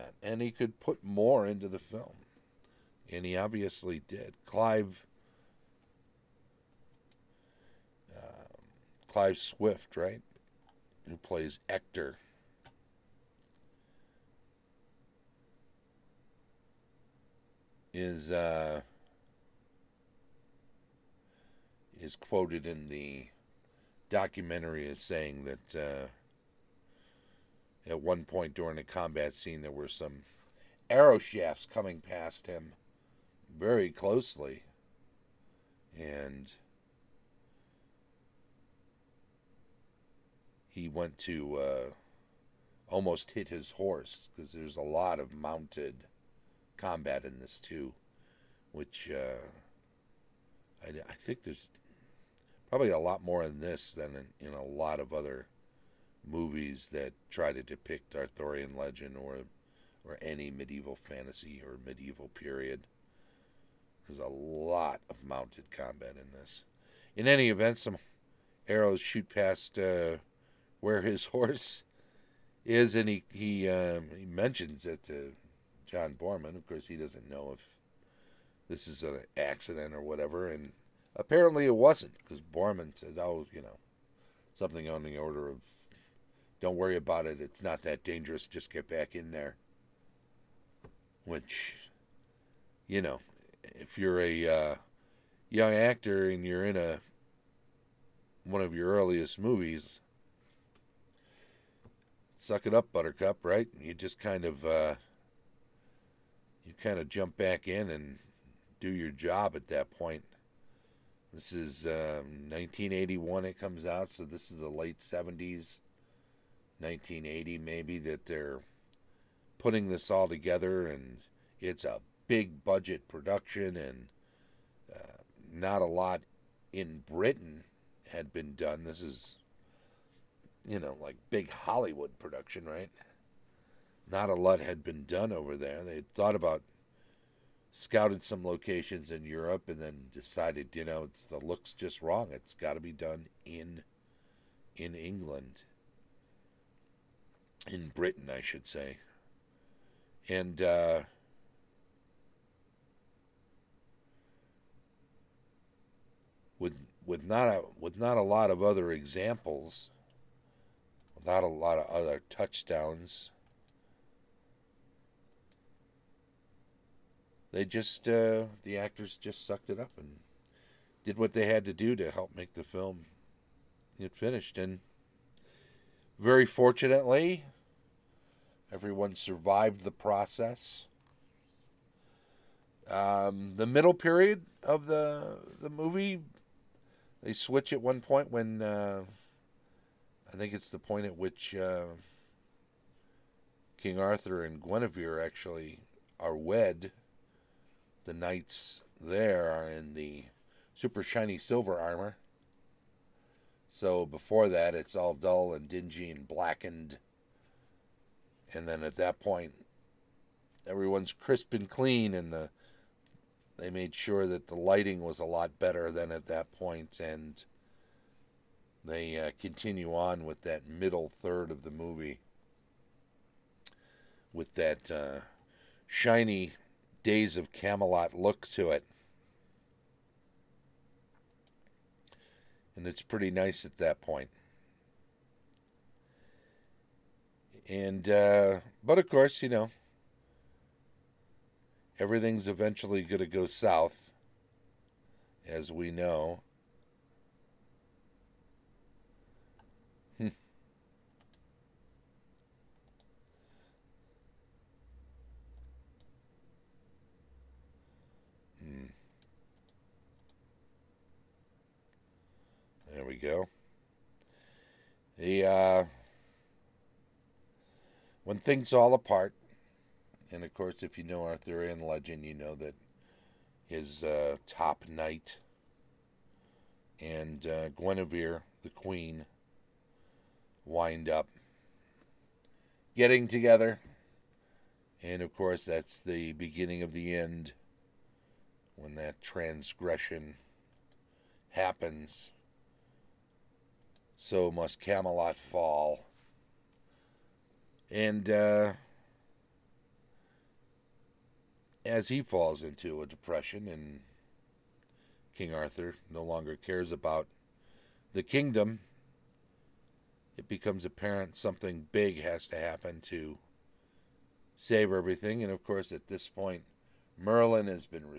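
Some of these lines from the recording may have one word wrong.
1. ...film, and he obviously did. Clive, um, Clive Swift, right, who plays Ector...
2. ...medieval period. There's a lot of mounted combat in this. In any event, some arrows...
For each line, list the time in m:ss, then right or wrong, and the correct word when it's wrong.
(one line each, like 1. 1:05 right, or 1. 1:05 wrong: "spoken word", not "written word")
1. 0:01 right
2. 1:01 right.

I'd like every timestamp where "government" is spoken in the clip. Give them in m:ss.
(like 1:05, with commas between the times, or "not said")
not said.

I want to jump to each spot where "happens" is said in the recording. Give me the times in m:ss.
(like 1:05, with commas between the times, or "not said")
4:51, 5:12.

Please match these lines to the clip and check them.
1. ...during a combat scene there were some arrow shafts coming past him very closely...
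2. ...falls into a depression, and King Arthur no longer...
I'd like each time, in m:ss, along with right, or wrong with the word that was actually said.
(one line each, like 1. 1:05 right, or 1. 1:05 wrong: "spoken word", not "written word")
1. 0:28 right
2. 5:02 right.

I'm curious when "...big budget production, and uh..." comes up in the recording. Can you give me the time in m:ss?
2:02.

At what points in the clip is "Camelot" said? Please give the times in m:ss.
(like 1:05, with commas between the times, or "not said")
3:47, 4:54.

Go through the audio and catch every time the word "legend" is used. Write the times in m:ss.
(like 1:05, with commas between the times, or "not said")
0:58, 4:31.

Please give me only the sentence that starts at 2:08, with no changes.
This is, you know, like big Hollywood production, right?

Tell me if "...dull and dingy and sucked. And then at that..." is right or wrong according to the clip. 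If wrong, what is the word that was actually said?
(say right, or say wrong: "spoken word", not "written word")
wrong: "blackened", not "sucked".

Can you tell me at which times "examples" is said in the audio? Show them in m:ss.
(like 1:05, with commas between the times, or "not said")
2:38.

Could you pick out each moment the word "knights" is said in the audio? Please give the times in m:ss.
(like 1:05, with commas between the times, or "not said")
3:18, 4:34.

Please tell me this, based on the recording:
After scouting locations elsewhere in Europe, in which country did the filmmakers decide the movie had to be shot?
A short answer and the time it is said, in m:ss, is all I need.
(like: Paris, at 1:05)
England, at 2:24.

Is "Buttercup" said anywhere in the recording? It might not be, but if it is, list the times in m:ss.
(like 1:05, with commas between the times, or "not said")
1:42.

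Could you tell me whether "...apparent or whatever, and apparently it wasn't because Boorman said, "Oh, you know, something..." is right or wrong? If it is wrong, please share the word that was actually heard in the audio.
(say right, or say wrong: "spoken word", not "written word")
wrong: "accident", not "apparent".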